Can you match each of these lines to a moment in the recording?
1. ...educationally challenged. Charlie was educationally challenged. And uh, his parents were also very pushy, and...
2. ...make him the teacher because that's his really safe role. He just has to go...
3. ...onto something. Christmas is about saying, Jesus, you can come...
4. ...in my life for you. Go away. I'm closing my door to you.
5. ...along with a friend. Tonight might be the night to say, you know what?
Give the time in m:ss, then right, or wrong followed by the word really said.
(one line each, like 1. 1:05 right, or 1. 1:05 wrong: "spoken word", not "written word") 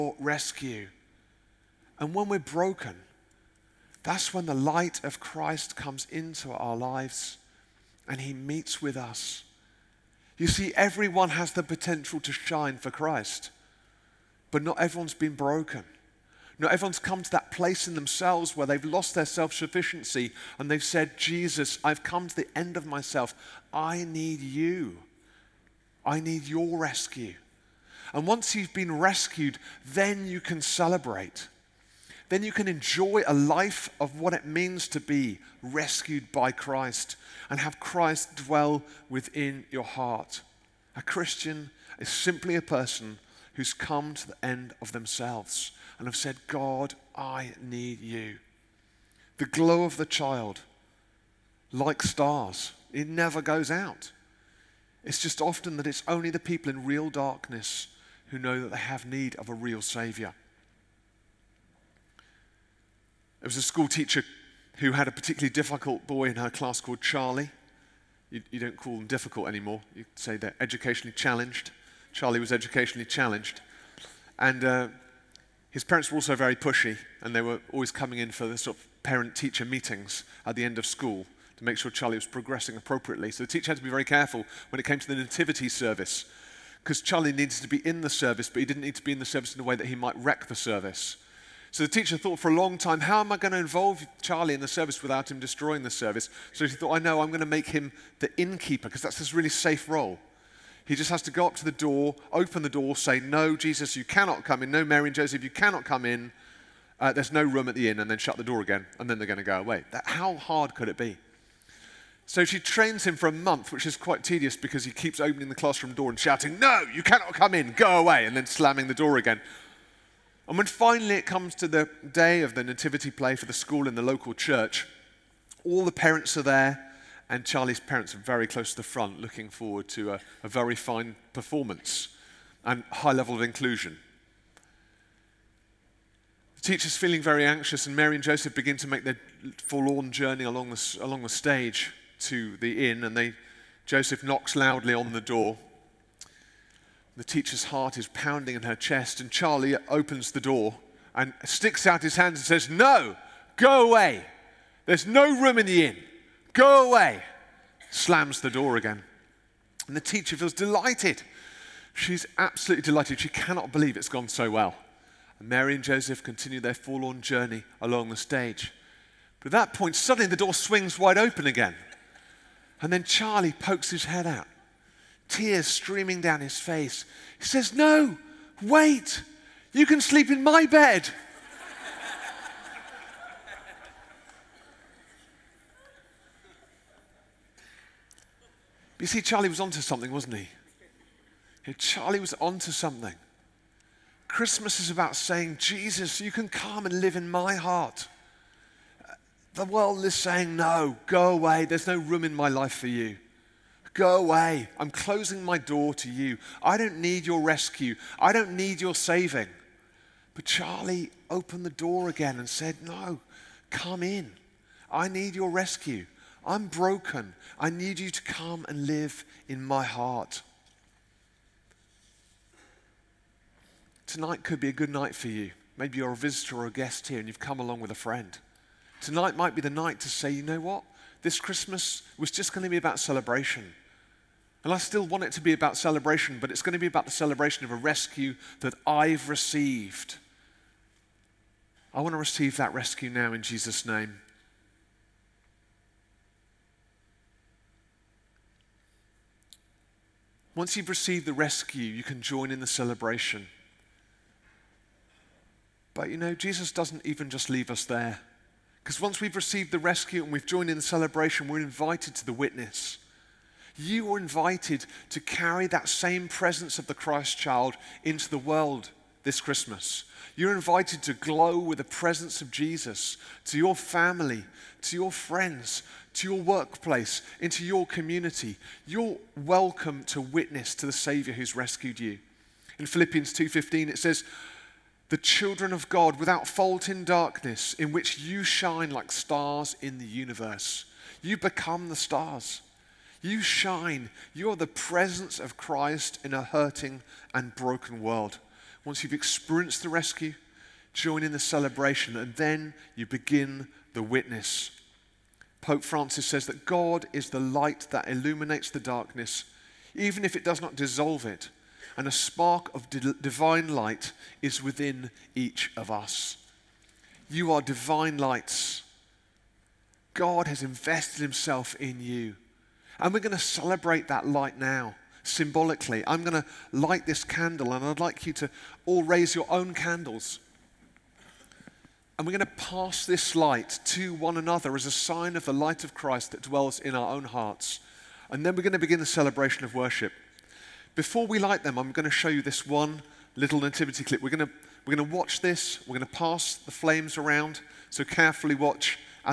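1. 1:10 right
2. 1:37 wrong: "innkeeper", not "teacher"
3. 3:12 right
4. 3:22 right
5. 3:47 right.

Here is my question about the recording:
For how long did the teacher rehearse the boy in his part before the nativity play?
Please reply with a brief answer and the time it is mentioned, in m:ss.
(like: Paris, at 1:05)
A month, at 1:53.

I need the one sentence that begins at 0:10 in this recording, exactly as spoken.
You see, everyone has the potential to shine for Christ, but not everyone's been broken.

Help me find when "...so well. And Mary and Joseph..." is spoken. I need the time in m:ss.
2:44.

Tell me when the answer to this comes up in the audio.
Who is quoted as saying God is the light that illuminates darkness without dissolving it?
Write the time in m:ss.
5:05.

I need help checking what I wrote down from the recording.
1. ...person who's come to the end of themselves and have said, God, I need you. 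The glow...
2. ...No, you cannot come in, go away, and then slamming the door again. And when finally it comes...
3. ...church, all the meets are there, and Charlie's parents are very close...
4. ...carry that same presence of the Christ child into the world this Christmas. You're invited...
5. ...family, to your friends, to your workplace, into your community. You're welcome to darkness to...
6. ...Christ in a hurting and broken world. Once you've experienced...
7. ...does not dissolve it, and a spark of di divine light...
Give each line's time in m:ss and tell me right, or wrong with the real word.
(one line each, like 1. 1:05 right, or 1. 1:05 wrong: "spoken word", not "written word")
1. 0:42 right
2. 1:56 right
3. 2:04 wrong: "parents", not "meets"
4. 4:25 right
5. 4:33 wrong: "witness", not "darkness"
6. 4:55 right
7. 5:10 right.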